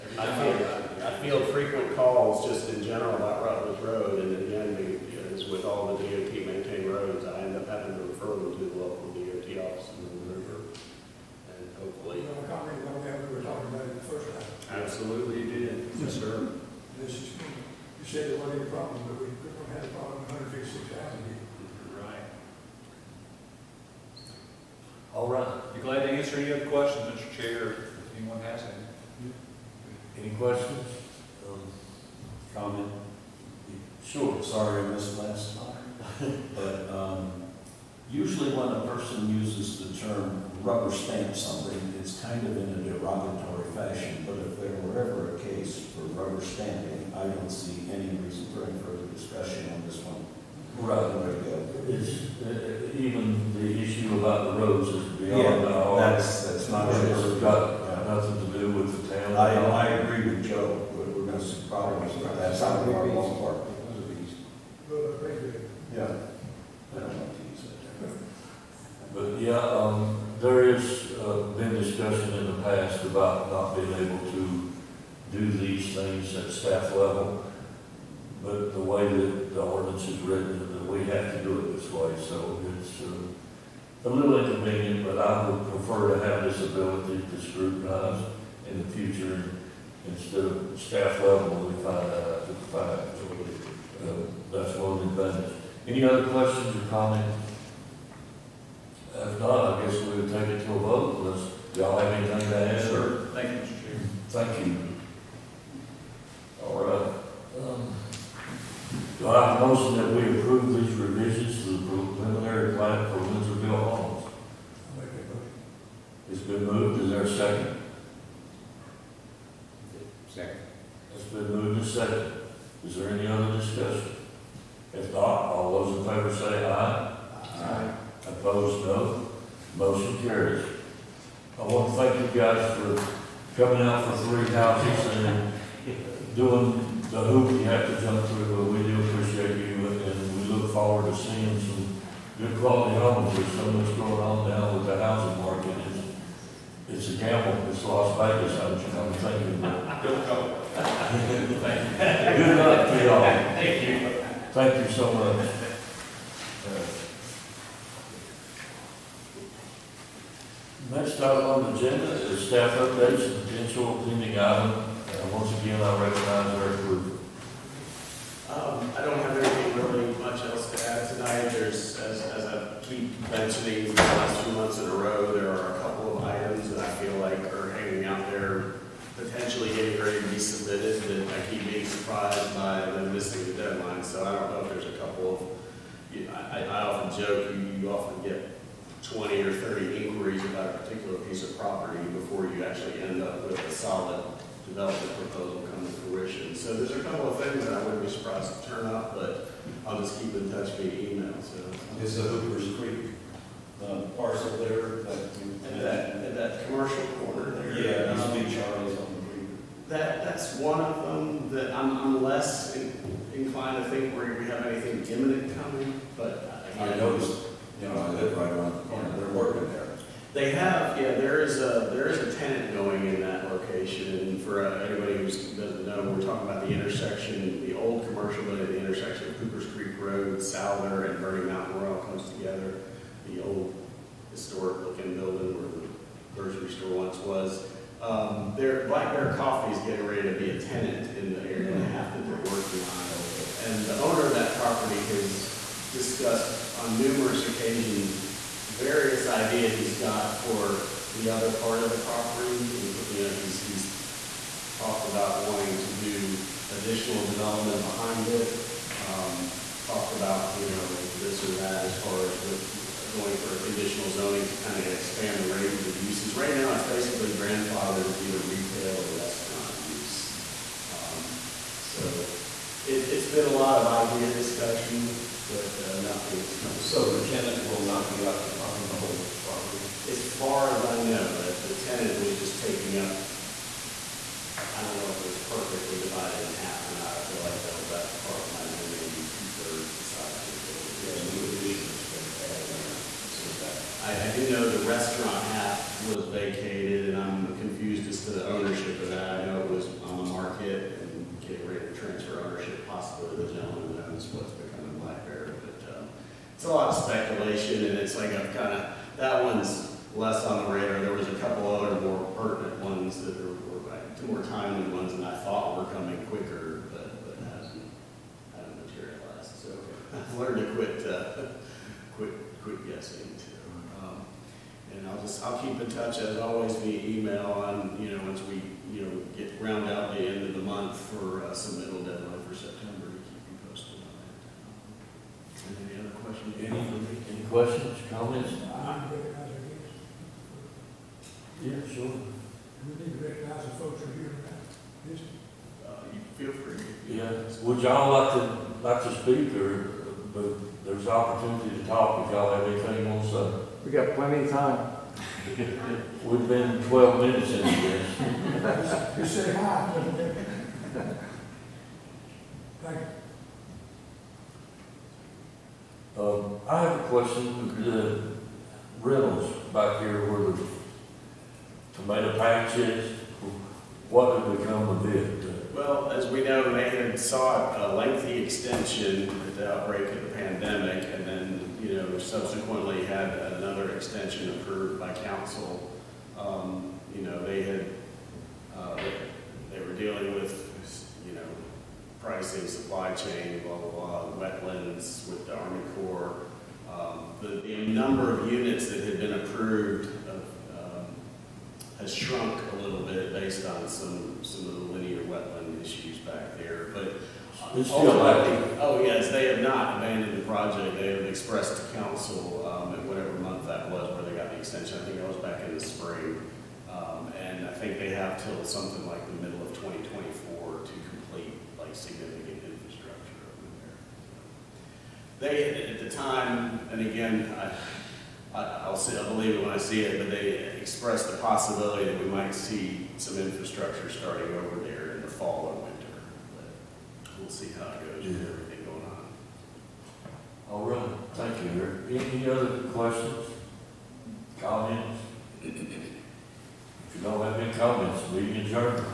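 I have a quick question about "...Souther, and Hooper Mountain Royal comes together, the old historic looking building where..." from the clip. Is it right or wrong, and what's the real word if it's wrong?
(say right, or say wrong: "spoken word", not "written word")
wrong: "Burning", not "Hooper".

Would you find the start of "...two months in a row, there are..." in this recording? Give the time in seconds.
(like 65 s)
174 s.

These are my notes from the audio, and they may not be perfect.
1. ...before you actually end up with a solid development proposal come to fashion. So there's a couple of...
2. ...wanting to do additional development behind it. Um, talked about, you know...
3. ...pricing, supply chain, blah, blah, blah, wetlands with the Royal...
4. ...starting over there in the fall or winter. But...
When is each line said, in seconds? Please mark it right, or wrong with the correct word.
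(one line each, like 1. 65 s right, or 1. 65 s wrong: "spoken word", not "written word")
1. 192 s wrong: "fruition", not "fashion"
2. 255 s right
3. 392 s wrong: "Army", not "Royal"
4. 434 s right.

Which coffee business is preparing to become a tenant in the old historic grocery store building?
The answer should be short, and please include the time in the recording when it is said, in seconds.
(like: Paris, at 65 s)
Black Bear Coffee, at 238 s.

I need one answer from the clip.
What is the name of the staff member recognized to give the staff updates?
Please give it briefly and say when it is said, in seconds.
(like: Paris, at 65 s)
Eric Rupert, at 166 s.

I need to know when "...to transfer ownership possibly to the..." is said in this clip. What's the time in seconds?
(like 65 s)
301 s.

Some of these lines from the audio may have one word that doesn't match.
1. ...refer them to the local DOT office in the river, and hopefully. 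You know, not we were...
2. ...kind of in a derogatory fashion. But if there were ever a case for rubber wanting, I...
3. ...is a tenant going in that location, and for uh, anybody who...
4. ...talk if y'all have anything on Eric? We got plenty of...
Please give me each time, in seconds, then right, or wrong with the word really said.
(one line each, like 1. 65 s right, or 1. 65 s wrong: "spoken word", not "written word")
1. 8 s right
2. 42 s wrong: "stamping", not "wanting"
3. 222 s right
4. 351 s wrong: "Sunday", not "Eric".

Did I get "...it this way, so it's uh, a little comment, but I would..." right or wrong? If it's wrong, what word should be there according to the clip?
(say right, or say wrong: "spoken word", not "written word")
wrong: "inconvenient", not "comment".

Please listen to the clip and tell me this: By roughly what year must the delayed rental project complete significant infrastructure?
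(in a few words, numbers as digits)
2024.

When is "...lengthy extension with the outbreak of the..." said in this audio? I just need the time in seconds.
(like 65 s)
377 s.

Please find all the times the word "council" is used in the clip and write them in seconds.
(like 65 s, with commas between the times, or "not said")
385 s, 411 s.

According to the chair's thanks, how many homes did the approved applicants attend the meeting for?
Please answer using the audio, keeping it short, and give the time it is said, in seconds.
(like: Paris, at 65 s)
3, at 134 s.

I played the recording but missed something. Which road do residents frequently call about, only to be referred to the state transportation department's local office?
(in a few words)
Rutledge Road.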